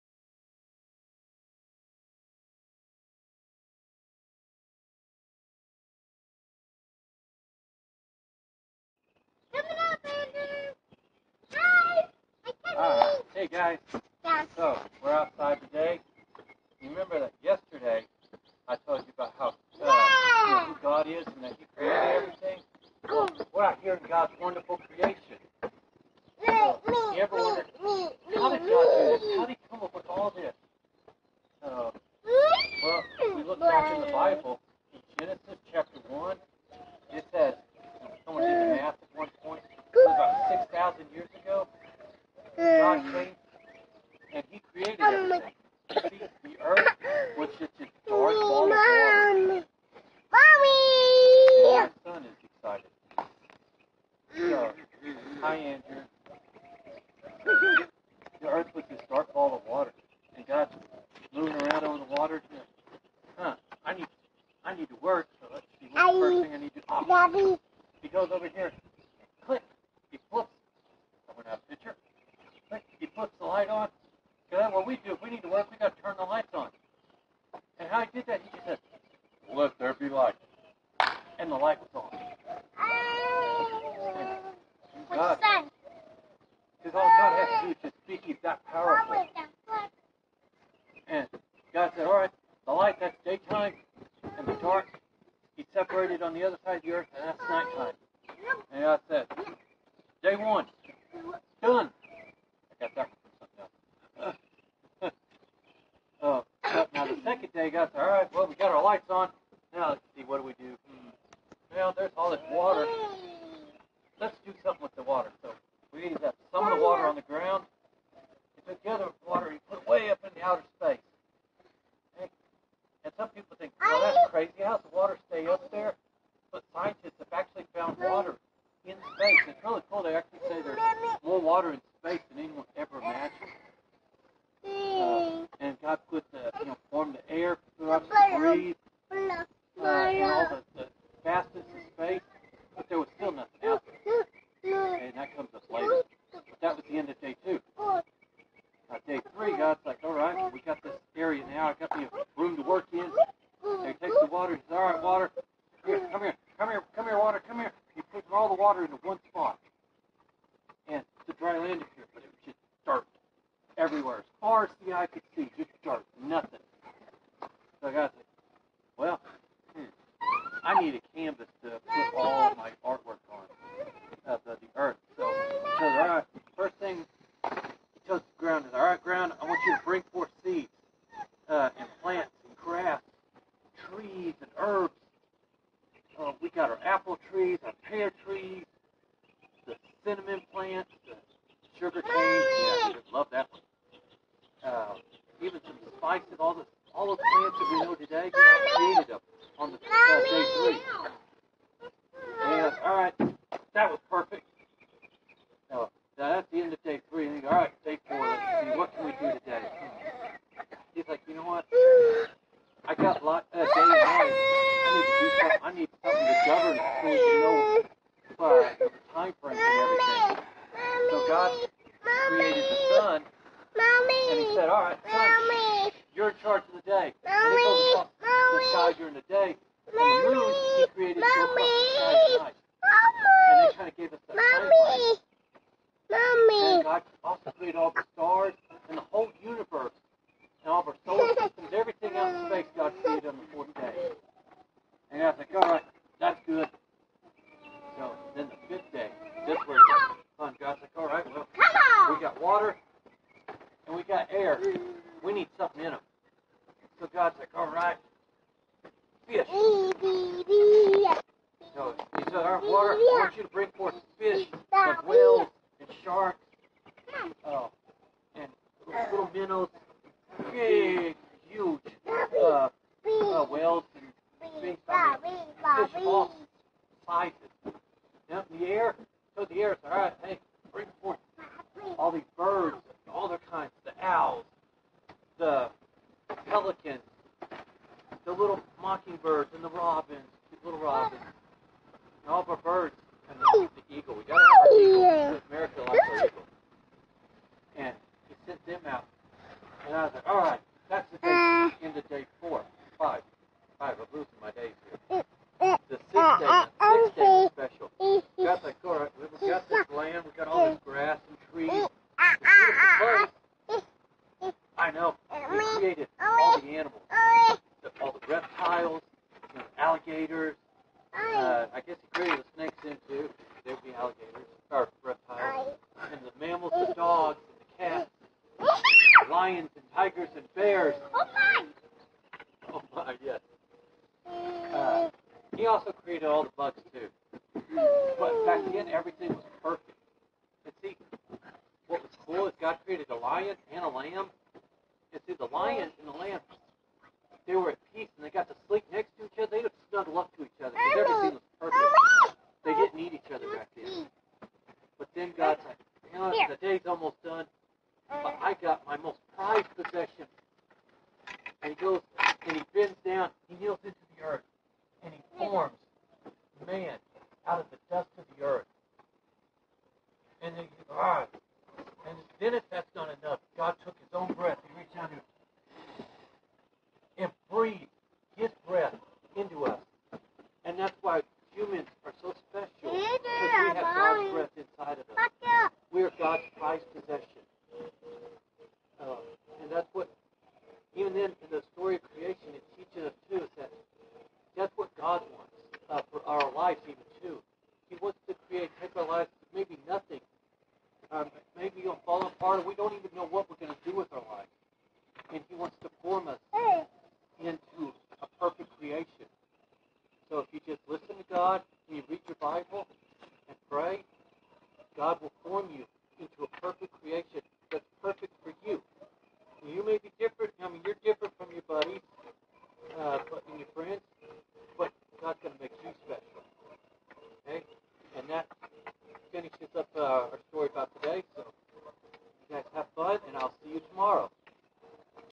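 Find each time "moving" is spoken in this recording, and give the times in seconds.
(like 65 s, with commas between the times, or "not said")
61 s.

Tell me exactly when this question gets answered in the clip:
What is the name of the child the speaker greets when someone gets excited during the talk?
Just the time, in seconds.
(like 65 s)
55 s.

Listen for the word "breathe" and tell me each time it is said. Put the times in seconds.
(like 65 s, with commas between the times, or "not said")
138 s.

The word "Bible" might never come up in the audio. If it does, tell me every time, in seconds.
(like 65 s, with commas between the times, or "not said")
34 s, 412 s.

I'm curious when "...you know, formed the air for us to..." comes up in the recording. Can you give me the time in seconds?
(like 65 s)
136 s.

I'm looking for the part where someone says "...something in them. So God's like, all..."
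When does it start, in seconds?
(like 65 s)
255 s.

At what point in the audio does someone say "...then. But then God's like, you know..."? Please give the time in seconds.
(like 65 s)
353 s.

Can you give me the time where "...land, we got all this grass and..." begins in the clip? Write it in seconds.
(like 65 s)
309 s.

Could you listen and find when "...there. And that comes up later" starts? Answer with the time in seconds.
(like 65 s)
144 s.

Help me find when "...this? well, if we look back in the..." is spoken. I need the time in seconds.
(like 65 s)
30 s.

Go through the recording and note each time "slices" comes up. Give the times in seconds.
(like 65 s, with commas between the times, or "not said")
277 s.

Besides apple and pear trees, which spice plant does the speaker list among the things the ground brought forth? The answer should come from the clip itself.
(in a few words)
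cinnamon.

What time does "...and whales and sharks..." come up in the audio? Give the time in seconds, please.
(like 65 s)
264 s.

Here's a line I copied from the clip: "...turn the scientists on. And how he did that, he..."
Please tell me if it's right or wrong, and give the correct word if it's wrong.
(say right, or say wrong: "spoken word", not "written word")
wrong: "lights", not "scientists".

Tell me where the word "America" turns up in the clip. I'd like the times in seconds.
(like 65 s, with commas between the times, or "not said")
295 s.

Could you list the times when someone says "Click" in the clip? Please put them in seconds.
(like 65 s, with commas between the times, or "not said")
69 s.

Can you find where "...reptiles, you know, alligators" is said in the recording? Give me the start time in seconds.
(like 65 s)
318 s.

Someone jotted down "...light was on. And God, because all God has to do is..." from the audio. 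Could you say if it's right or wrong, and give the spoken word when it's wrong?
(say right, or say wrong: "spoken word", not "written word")
right.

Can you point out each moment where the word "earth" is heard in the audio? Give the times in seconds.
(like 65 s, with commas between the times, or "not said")
46 s, 58 s, 96 s, 174 s, 364 s.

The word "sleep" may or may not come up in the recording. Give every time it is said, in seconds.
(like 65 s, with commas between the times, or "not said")
348 s.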